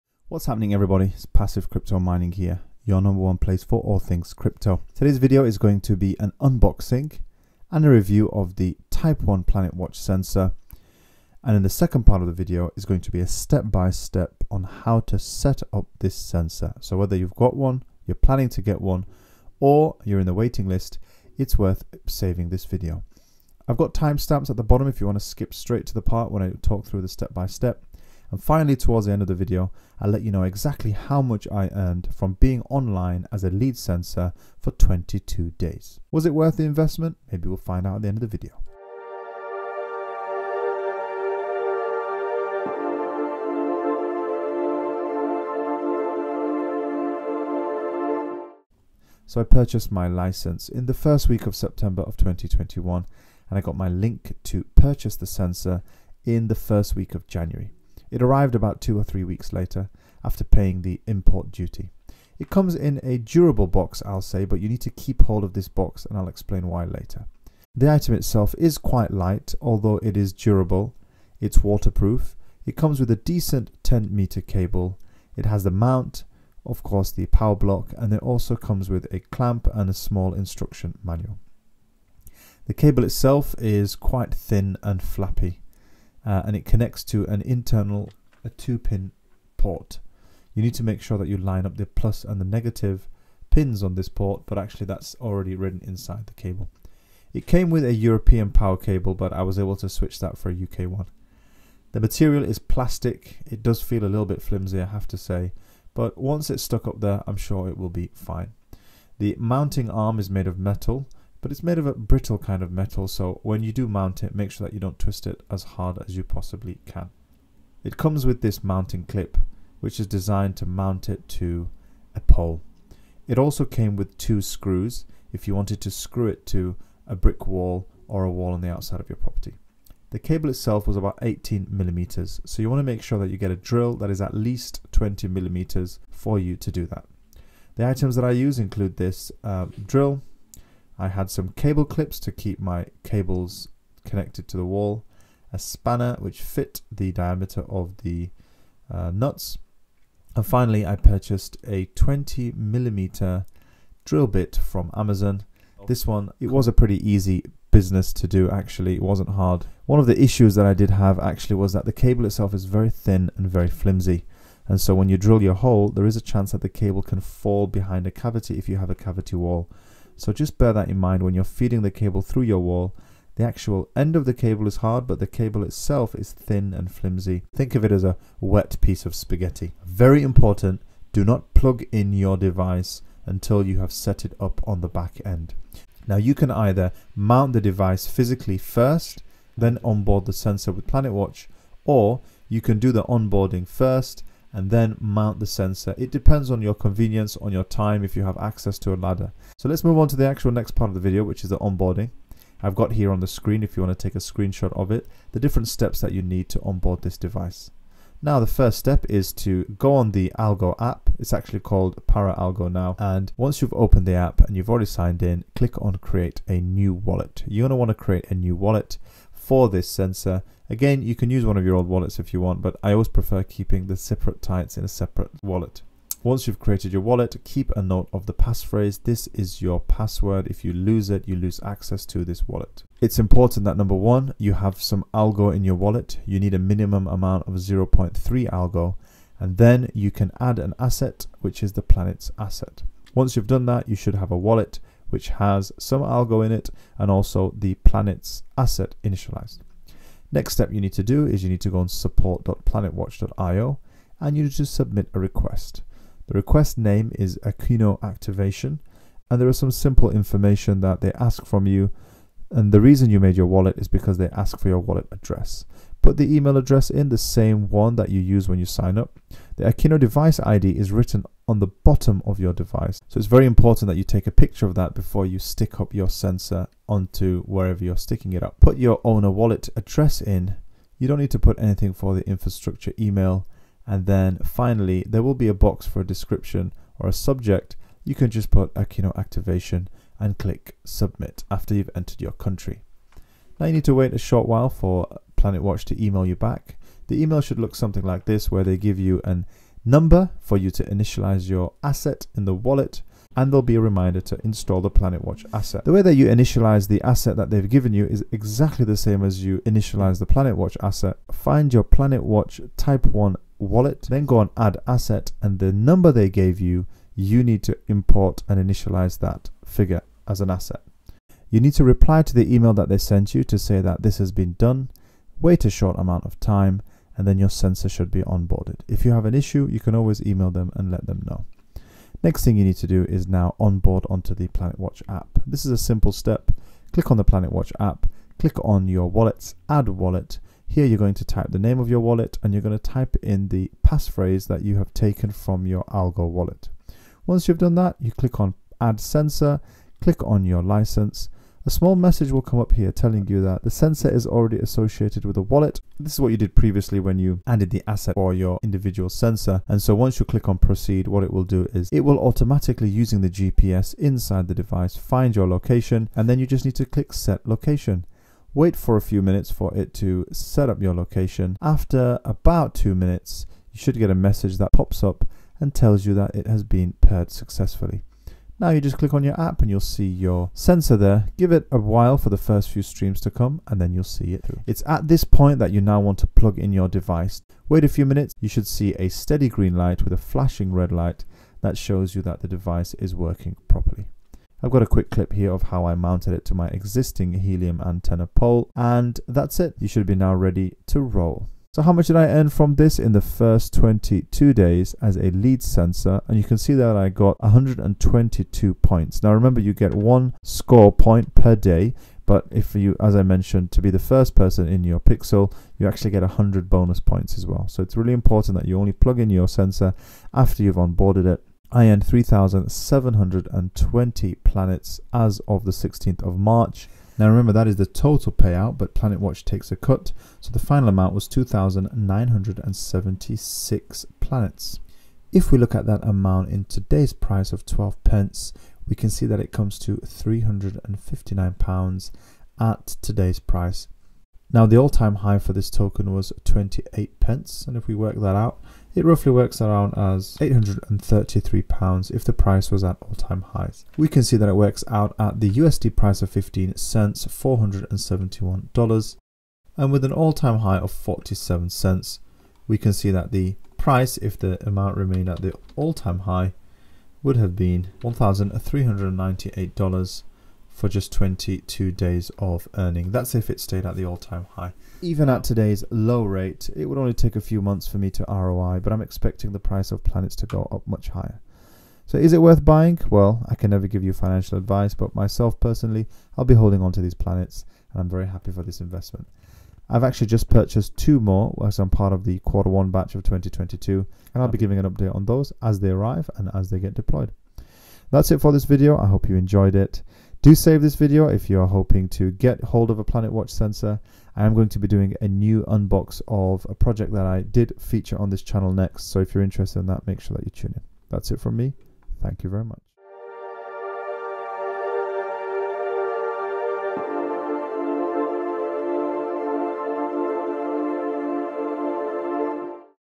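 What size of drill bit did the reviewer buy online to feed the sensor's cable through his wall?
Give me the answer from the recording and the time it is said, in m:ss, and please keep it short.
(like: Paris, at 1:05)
20 millimeter, at 2:31.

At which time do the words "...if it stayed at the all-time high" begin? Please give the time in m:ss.
7:53.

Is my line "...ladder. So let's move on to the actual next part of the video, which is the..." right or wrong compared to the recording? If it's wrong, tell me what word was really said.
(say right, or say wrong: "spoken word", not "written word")
right.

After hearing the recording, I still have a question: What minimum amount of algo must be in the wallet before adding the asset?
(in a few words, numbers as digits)
0.3 algo.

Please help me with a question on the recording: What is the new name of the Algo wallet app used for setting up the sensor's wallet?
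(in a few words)
Pera Algo.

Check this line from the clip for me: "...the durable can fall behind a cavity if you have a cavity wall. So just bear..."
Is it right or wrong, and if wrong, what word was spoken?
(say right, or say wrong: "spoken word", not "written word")
wrong: "cable", not "durable".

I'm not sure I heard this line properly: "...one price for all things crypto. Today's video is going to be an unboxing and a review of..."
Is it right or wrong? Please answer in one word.
wrong.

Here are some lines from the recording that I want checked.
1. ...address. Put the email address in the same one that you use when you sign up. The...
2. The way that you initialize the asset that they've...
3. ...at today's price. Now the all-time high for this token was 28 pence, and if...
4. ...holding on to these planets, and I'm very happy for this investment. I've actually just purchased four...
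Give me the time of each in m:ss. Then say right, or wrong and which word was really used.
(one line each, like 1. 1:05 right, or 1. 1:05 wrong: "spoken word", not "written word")
1. 4:25 right
2. 5:05 right
3. 7:22 right
4. 8:06 wrong: "two", not "four".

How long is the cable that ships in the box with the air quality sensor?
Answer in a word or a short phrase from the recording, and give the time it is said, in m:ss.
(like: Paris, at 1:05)
10 meter, at 1:13.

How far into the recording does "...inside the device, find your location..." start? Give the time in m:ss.
6:03.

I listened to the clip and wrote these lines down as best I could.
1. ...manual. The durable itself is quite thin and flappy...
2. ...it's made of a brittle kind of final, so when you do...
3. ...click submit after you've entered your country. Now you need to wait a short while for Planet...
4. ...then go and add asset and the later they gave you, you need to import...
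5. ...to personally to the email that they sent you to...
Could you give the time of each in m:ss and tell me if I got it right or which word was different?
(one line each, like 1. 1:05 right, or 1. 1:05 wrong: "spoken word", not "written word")
1. 1:21 wrong: "cable", not "durable"
2. 1:51 wrong: "metal", not "final"
3. 4:50 right
4. 5:14 wrong: "number", not "later"
5. 5:21 wrong: "reply", not "personally".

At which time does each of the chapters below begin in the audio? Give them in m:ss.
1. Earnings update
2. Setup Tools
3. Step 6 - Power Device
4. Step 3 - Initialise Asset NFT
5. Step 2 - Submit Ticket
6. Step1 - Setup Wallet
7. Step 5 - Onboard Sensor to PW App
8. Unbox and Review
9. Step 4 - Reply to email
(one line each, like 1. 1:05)
1. 6:41
2. 2:09
3. 6:24
4. 4:52
5. 4:08
6. 3:18
7. 5:30
8. 0:48
9. 5:19.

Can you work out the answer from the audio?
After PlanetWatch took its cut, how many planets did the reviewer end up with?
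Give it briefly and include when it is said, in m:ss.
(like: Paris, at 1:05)
2,976, at 7:11.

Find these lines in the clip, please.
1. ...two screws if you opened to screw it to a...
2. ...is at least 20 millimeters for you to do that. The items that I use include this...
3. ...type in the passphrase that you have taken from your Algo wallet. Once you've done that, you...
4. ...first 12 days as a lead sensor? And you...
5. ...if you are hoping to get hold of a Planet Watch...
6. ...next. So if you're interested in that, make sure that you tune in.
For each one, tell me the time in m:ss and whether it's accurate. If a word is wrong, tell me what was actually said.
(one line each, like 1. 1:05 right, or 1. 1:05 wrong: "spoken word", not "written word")
1. 2:04 wrong: "wanted", not "opened"
2. 2:14 right
3. 5:42 right
4. 6:43 wrong: "22", not "12"
5. 8:21 right
6. 8:28 right.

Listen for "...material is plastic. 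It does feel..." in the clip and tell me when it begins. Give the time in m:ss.
1:41.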